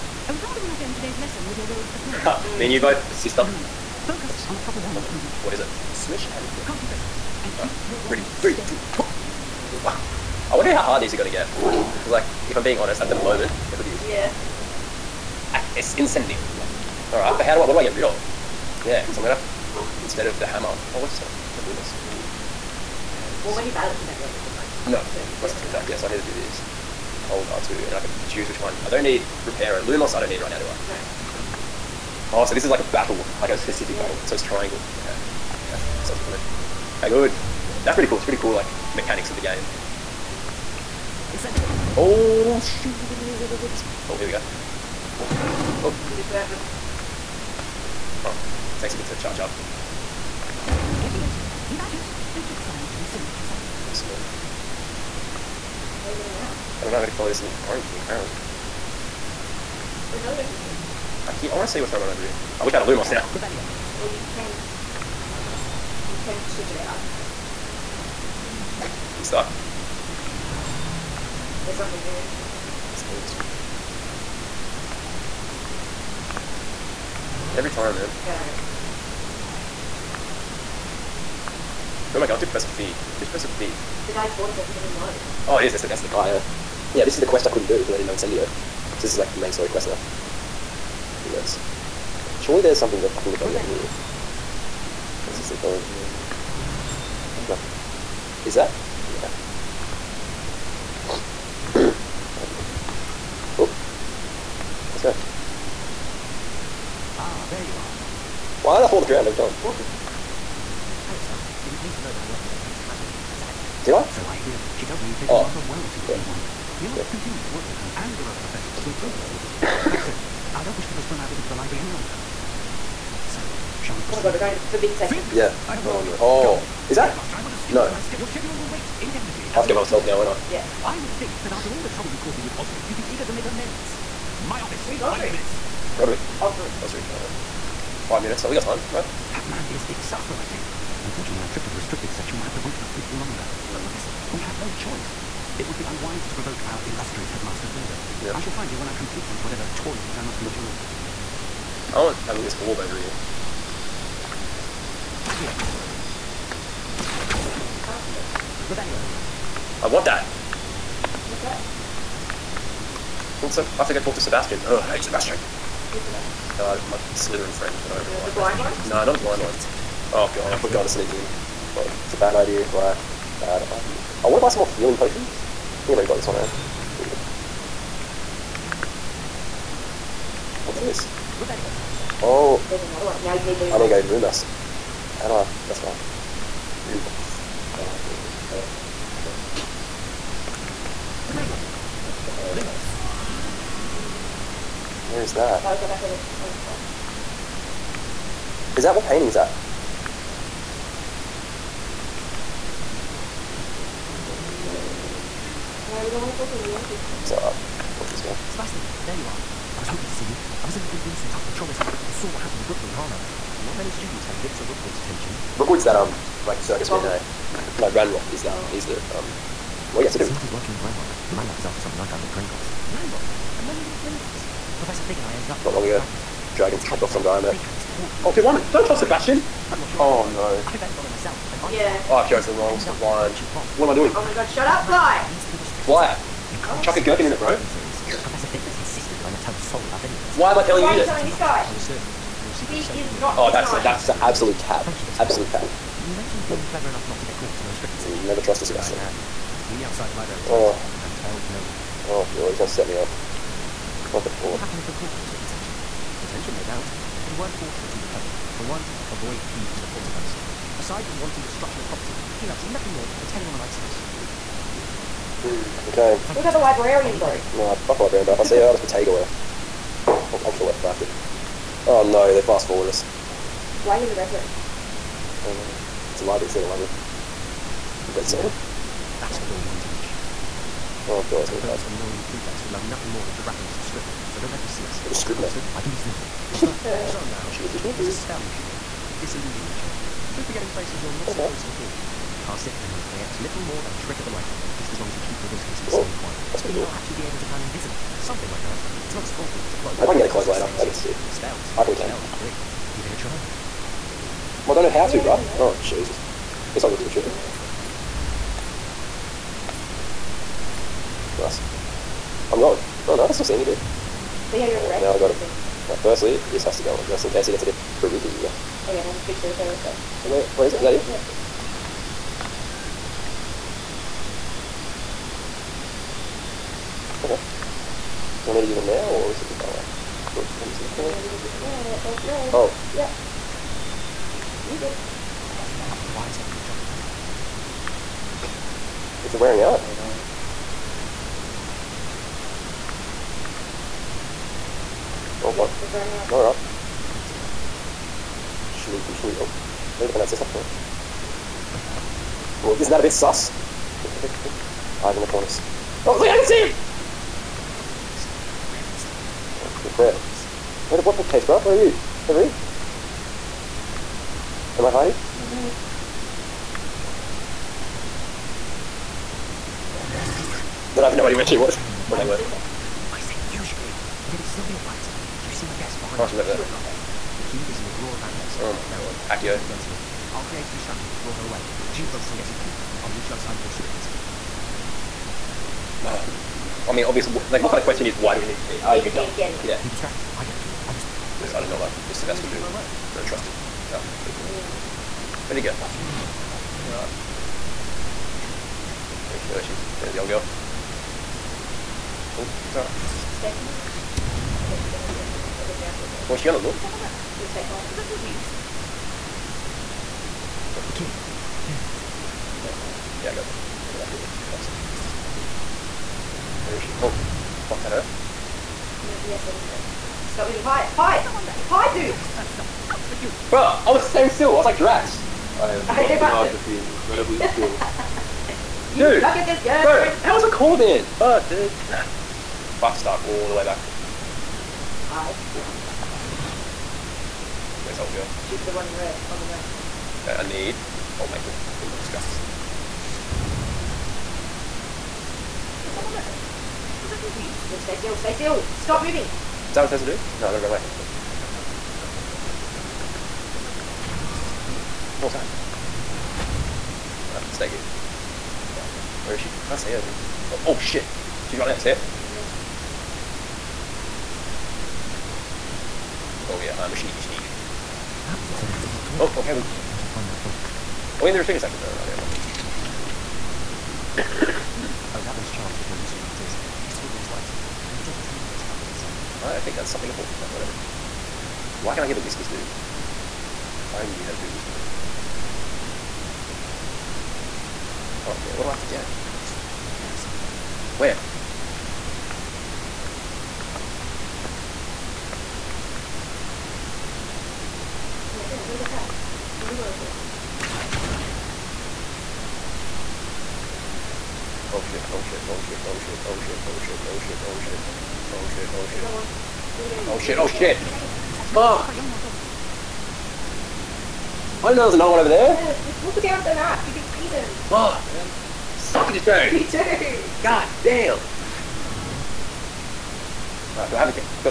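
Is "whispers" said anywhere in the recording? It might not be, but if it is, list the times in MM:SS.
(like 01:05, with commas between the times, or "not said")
08:02.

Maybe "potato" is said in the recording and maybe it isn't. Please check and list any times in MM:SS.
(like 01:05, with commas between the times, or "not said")
03:11, 04:28.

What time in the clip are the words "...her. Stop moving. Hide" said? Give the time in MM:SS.
06:59.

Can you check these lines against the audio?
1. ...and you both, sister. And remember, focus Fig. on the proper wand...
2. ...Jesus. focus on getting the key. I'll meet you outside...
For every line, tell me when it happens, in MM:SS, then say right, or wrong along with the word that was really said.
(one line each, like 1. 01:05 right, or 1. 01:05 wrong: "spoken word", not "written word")
1. 00:02 wrong: "Oops", not "Fig"
2. 06:21 right.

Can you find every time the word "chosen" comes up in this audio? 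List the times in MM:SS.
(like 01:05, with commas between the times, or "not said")
03:52.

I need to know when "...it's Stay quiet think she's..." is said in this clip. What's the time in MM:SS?
06:42.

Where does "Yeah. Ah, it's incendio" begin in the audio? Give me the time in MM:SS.
00:14.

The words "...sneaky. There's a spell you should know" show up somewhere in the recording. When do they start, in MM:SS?
04:47.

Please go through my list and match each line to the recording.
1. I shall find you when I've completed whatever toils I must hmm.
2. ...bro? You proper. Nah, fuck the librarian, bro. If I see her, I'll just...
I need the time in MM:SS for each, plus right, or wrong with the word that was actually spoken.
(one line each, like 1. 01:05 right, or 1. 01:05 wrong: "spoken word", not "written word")
1. 02:28 right
2. 04:27 wrong: "later", not "proper".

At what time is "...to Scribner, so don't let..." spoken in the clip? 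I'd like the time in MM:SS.
04:43.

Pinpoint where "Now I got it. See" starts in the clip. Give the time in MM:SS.
05:15.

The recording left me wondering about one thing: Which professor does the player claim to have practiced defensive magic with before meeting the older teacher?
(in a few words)
Professor Hecat.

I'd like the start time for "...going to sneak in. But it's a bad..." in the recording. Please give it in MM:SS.
02:50.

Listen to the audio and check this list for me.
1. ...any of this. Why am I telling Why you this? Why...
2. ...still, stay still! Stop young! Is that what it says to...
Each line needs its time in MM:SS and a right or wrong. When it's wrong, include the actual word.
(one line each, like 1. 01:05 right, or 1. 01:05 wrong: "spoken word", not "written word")
1. 04:00 right
2. 07:27 wrong: "moving", not "young".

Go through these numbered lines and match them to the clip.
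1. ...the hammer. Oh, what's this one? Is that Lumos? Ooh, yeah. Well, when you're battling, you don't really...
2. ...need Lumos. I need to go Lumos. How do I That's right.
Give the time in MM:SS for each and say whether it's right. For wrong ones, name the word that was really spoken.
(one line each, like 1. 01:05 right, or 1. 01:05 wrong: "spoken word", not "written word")
1. 00:20 right
2. 03:03 right.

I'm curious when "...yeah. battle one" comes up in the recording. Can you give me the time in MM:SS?
00:33.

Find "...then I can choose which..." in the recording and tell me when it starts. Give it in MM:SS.
00:27.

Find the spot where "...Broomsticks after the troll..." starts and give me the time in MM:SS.
03:31.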